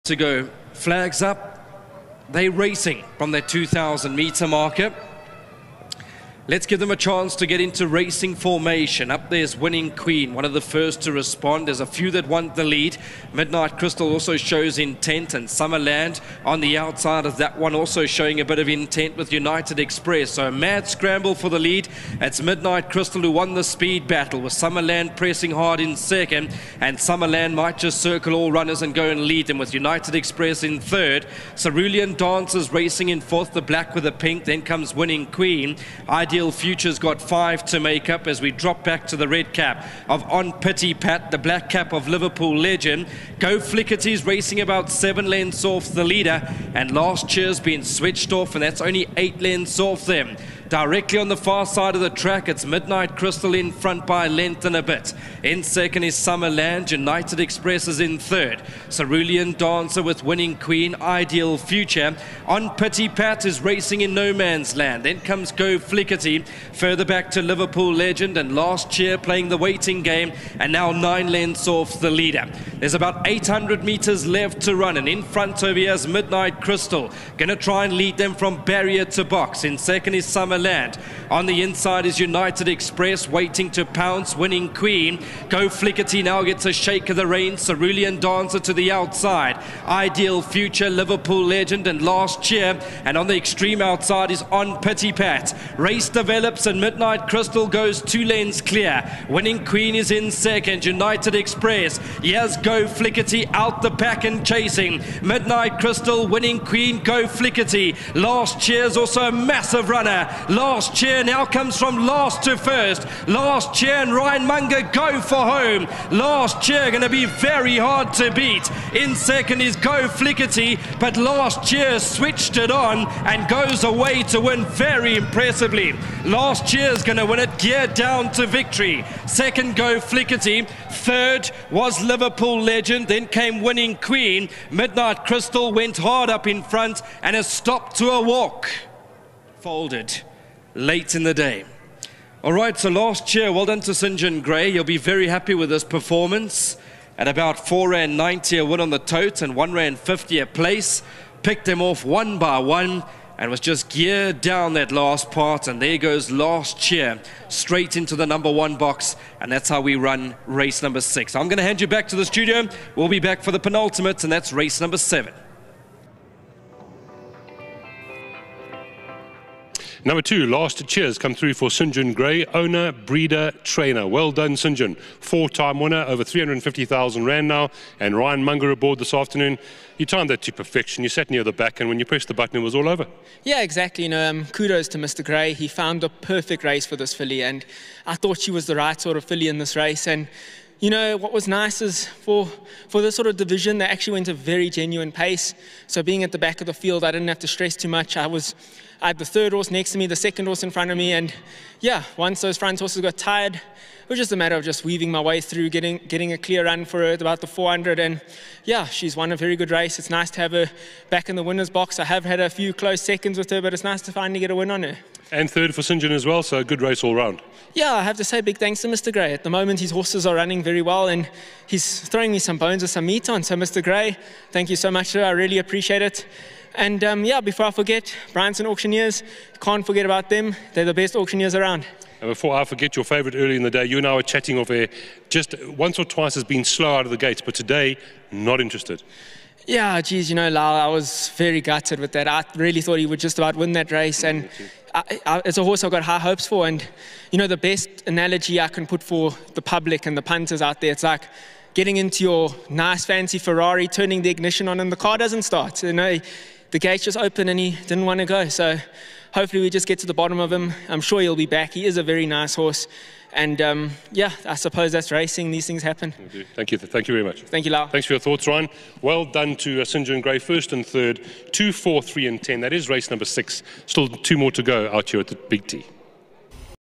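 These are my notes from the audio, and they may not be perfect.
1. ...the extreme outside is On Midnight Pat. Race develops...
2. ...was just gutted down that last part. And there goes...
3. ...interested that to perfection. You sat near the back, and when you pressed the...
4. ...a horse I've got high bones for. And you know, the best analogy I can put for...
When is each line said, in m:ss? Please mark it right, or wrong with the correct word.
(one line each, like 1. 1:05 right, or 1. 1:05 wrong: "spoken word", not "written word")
1. 1:33 wrong: "Pity", not "Midnight"
2. 2:33 wrong: "geared", not "gutted"
3. 3:00 wrong: "timed", not "interested"
4. 4:05 wrong: "hopes", not "bones".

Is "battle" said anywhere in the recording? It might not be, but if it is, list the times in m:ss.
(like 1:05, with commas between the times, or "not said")
0:24.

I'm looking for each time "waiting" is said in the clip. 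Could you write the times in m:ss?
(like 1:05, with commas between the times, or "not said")
1:09, 1:23.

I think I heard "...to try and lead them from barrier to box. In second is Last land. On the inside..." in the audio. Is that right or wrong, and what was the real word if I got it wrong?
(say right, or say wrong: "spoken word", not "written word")
wrong: "Summerland", not "Last".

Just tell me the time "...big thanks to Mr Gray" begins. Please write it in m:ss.
3:38.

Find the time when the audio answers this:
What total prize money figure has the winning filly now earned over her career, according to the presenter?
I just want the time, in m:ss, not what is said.
2:56.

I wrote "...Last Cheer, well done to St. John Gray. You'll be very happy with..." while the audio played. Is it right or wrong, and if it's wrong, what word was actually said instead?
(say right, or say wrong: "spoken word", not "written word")
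right.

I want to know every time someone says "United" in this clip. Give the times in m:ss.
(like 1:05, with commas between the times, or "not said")
0:19, 0:29, 0:56, 1:22, 1:40.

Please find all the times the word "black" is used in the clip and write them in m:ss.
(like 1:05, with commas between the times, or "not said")
0:33, 0:41.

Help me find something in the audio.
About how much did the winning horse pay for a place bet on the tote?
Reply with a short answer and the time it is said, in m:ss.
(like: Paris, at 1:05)
1 Rand 50, at 2:29.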